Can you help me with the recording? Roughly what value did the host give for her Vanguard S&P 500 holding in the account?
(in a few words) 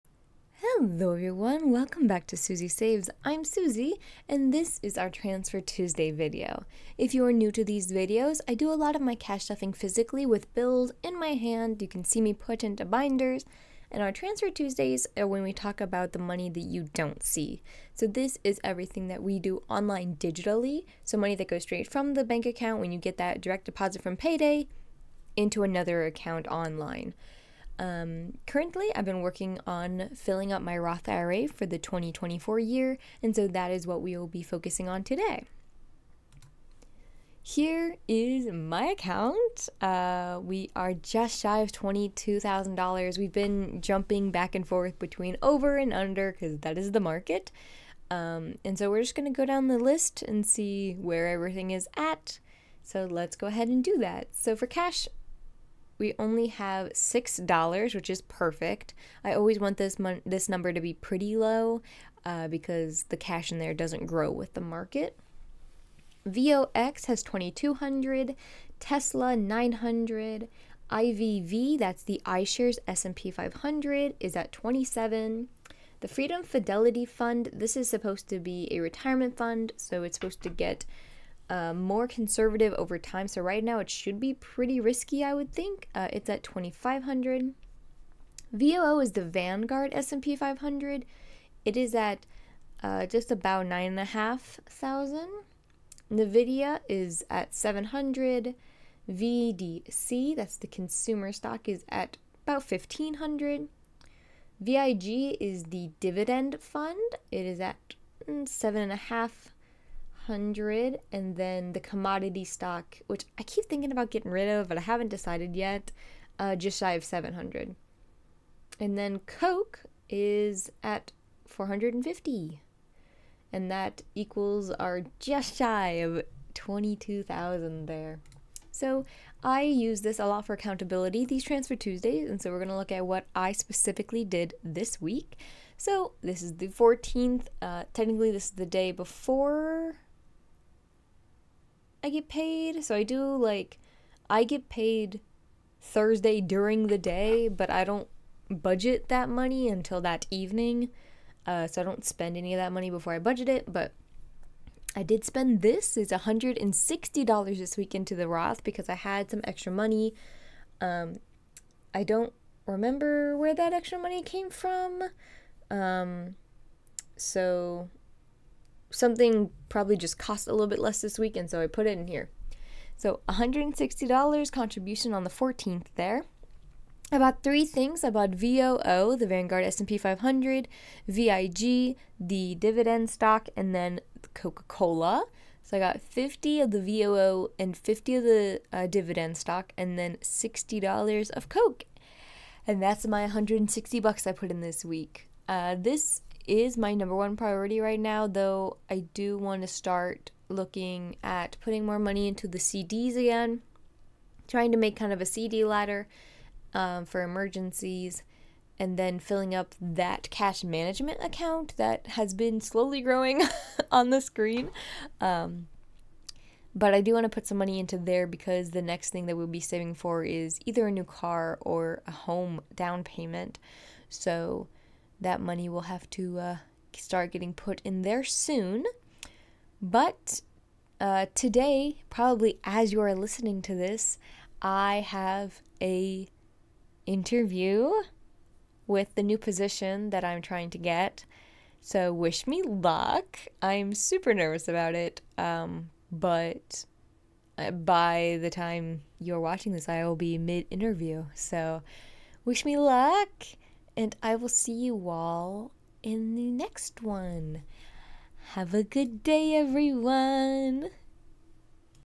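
9,500.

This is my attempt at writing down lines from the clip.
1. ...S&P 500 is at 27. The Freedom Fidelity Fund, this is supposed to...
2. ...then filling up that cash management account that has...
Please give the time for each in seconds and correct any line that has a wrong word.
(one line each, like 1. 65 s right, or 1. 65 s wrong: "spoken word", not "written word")
1. 72 s right
2. 208 s right.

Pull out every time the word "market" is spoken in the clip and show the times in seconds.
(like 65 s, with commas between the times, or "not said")
46 s, 64 s.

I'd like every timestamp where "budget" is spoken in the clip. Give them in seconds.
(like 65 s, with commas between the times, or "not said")
148 s, 153 s.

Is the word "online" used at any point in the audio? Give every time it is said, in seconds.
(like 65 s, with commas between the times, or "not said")
19 s, 26 s.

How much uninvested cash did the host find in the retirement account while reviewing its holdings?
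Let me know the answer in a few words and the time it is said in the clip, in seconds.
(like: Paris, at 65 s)
$6, at 56 s.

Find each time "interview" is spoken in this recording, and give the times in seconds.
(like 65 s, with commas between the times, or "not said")
237 s, 250 s.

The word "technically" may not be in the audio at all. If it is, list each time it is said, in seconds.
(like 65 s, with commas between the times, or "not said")
137 s.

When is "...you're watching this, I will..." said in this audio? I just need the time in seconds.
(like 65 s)
249 s.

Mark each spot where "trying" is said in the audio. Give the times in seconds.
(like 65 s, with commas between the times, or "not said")
204 s, 240 s.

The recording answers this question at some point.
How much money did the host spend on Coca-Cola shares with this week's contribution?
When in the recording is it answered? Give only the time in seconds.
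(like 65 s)
190 s.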